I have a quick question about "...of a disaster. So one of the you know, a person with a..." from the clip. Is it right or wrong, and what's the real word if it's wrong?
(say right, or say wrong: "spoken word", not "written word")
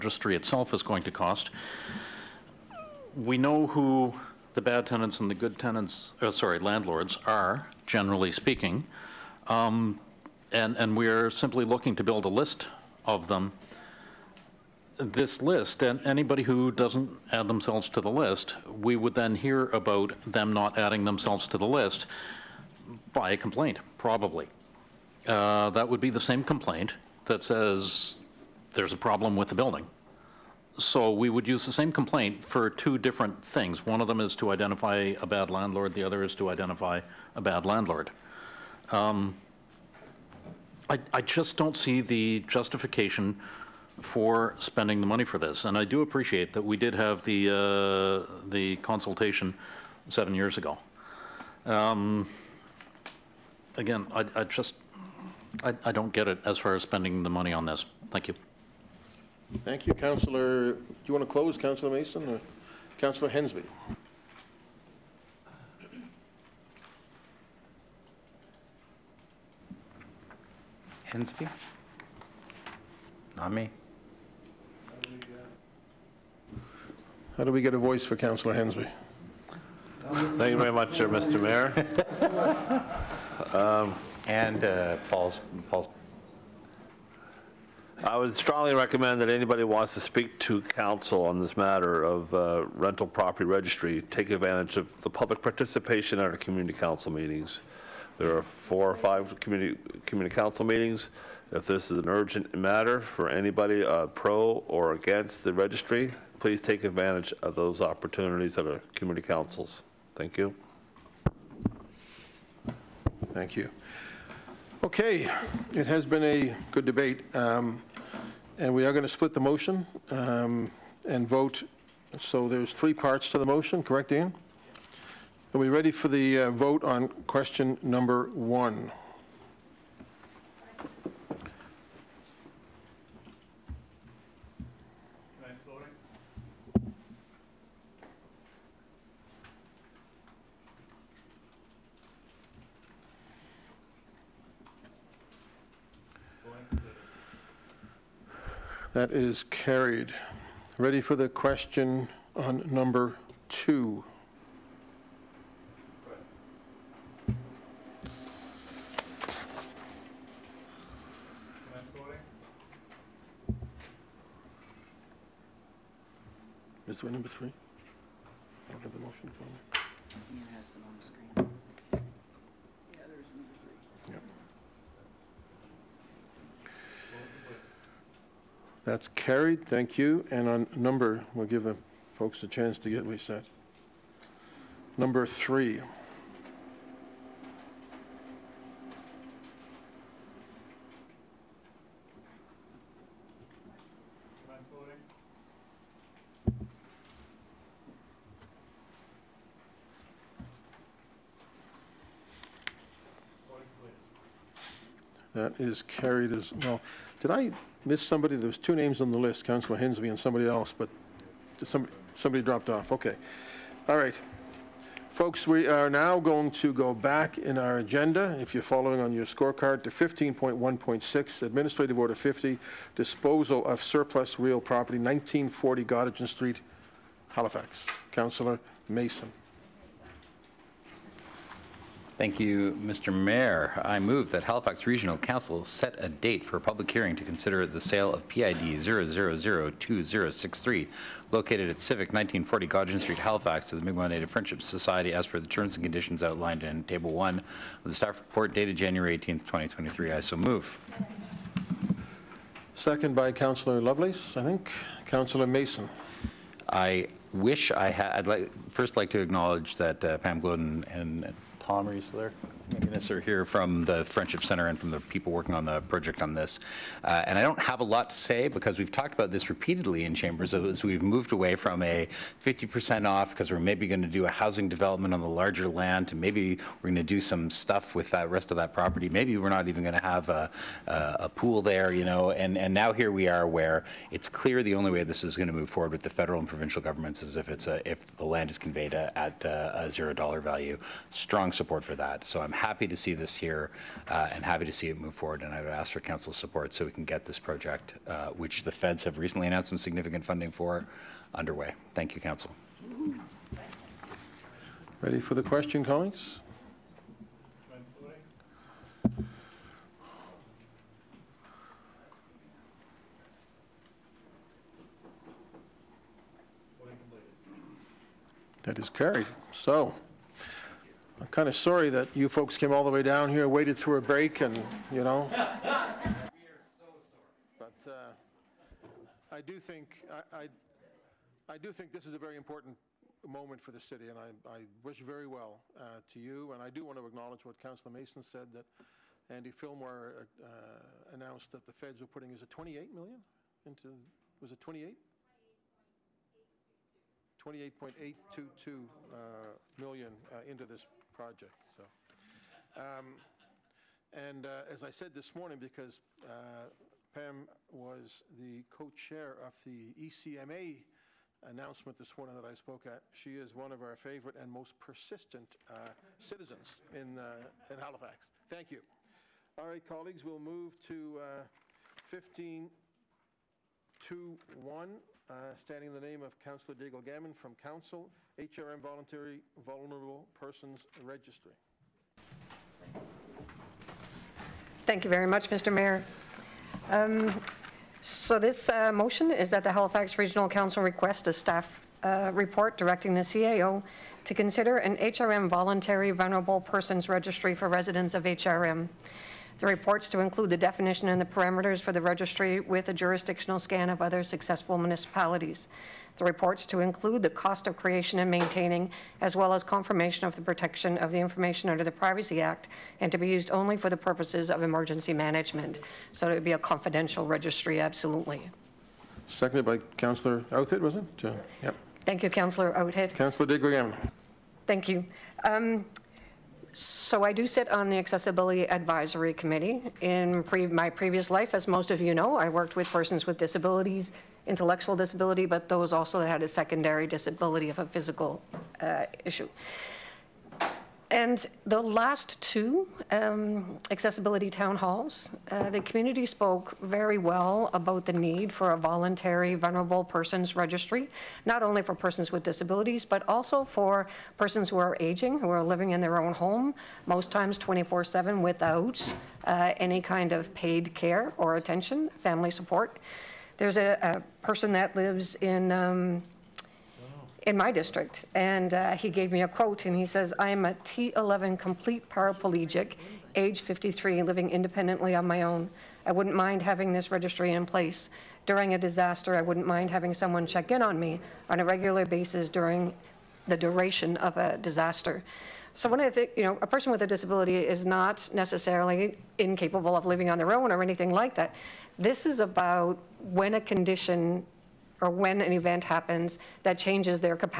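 right.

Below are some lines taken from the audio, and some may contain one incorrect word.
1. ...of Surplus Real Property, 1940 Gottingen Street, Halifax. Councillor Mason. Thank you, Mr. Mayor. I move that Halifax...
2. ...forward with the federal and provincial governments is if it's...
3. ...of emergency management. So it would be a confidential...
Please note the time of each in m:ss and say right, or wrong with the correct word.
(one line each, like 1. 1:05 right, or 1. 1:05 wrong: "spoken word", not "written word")
1. 3:43 right
2. 4:45 right
3. 6:54 right.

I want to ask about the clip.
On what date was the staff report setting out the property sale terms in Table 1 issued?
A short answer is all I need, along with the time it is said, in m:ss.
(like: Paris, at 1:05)
January 18, 2023, at 4:08.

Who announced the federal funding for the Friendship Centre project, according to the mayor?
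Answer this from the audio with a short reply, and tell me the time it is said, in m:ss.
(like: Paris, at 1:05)
Andy Fillmore, at 5:39.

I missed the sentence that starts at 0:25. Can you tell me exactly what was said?
Uh, that would be the same complaint that says there's a problem with the building.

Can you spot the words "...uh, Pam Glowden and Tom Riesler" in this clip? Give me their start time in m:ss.
4:20.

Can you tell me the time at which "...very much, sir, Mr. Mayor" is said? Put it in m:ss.
1:20.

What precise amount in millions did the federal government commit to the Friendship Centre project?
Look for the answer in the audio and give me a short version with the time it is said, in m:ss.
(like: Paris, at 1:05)
28.822 million, at 5:47.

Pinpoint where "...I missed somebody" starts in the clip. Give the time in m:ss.
3:27.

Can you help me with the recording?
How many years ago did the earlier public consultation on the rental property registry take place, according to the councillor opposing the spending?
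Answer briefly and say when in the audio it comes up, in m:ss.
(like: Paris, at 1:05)
7, at 0:50.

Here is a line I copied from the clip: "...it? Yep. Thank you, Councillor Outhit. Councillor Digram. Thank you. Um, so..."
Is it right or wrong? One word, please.
right.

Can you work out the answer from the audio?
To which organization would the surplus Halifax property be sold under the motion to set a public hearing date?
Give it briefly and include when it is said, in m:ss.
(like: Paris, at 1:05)
Mi'kmaq Native Friendship Society, at 4:03.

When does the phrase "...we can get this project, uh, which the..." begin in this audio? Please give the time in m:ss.
4:56.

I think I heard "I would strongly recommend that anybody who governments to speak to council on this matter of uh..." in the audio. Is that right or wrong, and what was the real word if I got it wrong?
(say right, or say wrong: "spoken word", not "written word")
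wrong: "wants", not "governments".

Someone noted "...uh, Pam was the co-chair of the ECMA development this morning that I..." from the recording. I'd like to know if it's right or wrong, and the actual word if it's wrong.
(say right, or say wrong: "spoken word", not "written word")
wrong: "announcement", not "development".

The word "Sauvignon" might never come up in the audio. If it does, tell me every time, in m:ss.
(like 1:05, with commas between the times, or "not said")
not said.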